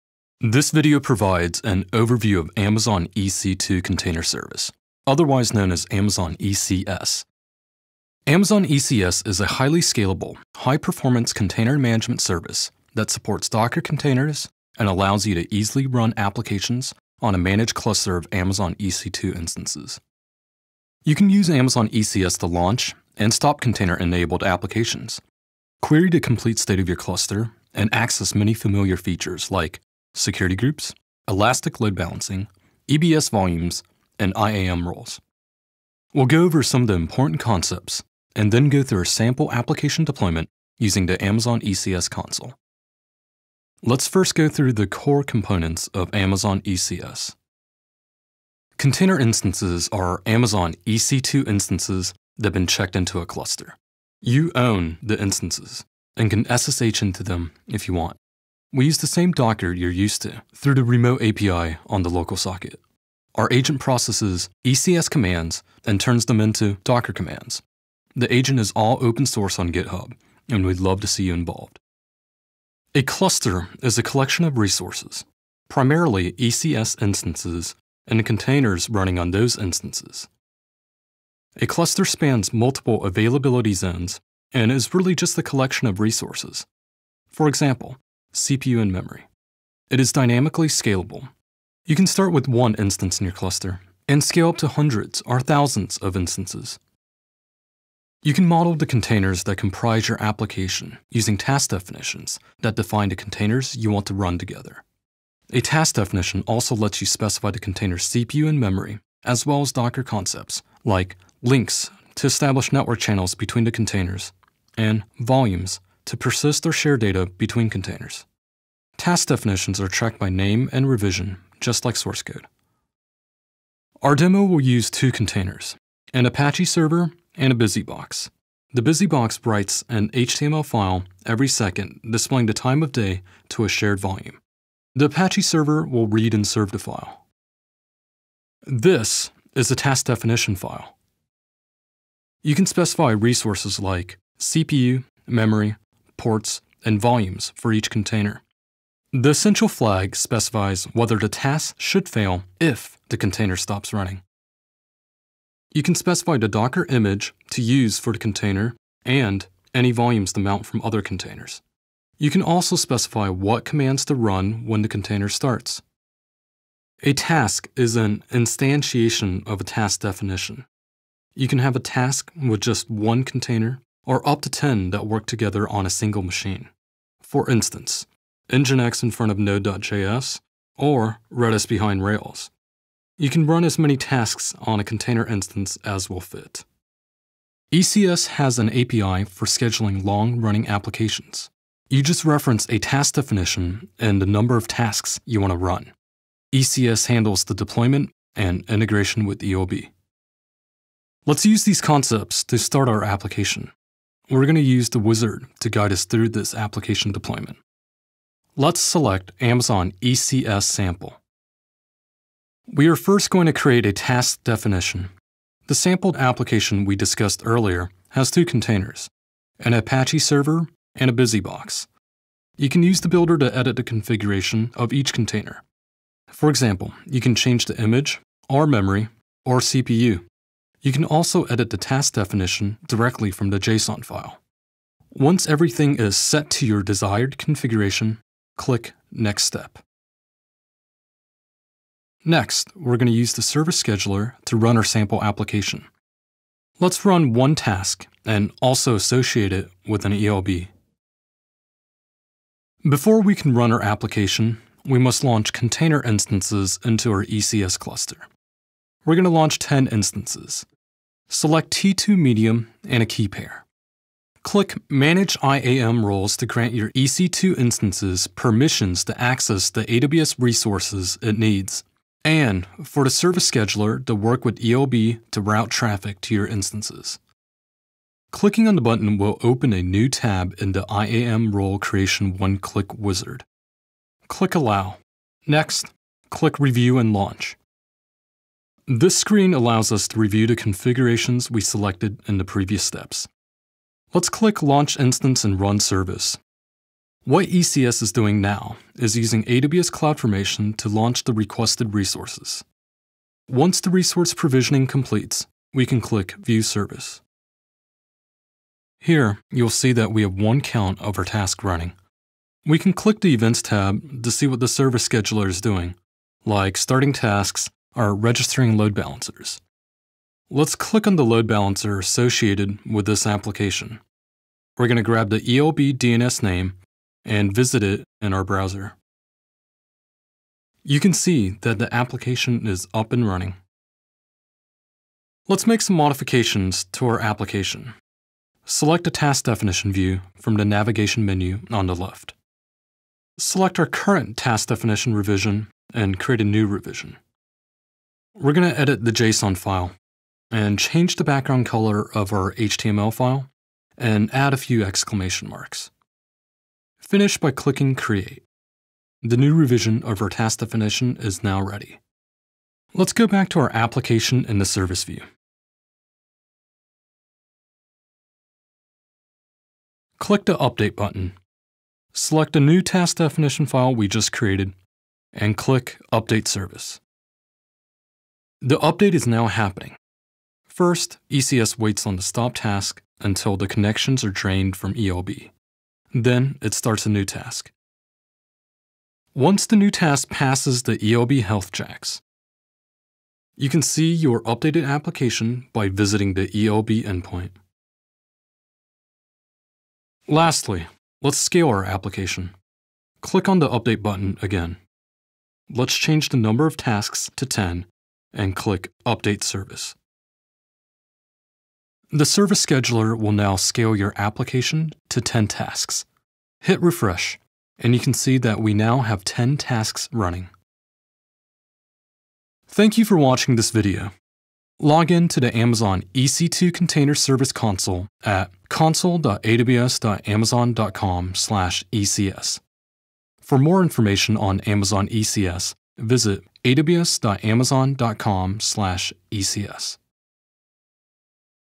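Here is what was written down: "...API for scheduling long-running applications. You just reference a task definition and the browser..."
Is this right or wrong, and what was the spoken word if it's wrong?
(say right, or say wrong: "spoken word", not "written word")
wrong: "number", not "browser".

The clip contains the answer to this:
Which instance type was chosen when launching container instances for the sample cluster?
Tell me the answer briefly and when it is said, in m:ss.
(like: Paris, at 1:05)
T2 Medium, at 4:21.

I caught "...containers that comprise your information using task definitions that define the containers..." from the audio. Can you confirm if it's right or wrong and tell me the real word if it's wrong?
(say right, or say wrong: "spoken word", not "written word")
wrong: "application", not "information".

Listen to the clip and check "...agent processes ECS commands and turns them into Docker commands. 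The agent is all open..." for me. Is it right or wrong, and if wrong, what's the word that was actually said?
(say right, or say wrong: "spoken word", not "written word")
right.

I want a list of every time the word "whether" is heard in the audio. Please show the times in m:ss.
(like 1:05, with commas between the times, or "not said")
2:30.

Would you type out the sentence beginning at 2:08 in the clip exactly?
The BusyBox writes an HTML file every second displaying the time of day to a shared volume.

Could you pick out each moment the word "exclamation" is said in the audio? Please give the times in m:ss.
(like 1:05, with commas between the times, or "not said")
5:54.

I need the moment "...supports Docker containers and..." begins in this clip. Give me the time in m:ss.
0:13.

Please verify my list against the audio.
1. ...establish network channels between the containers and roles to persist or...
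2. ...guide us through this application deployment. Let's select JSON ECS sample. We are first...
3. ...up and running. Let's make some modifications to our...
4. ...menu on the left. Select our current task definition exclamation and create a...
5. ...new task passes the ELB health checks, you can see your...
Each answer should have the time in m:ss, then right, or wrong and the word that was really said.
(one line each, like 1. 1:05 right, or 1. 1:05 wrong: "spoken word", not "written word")
1. 1:52 wrong: "volumes", not "roles"
2. 3:25 wrong: "Amazon", not "JSON"
3. 5:32 right
4. 5:41 wrong: "revision", not "exclamation"
5. 6:29 right.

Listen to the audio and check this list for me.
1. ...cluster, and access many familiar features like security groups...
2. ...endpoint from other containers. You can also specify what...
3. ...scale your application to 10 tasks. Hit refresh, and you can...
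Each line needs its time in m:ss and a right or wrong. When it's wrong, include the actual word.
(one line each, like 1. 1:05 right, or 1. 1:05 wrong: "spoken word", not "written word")
1. 0:26 right
2. 2:40 wrong: "mount", not "endpoint"
3. 6:53 right.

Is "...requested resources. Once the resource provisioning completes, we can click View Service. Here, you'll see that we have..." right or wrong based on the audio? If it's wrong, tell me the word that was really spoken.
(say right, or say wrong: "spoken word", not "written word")
right.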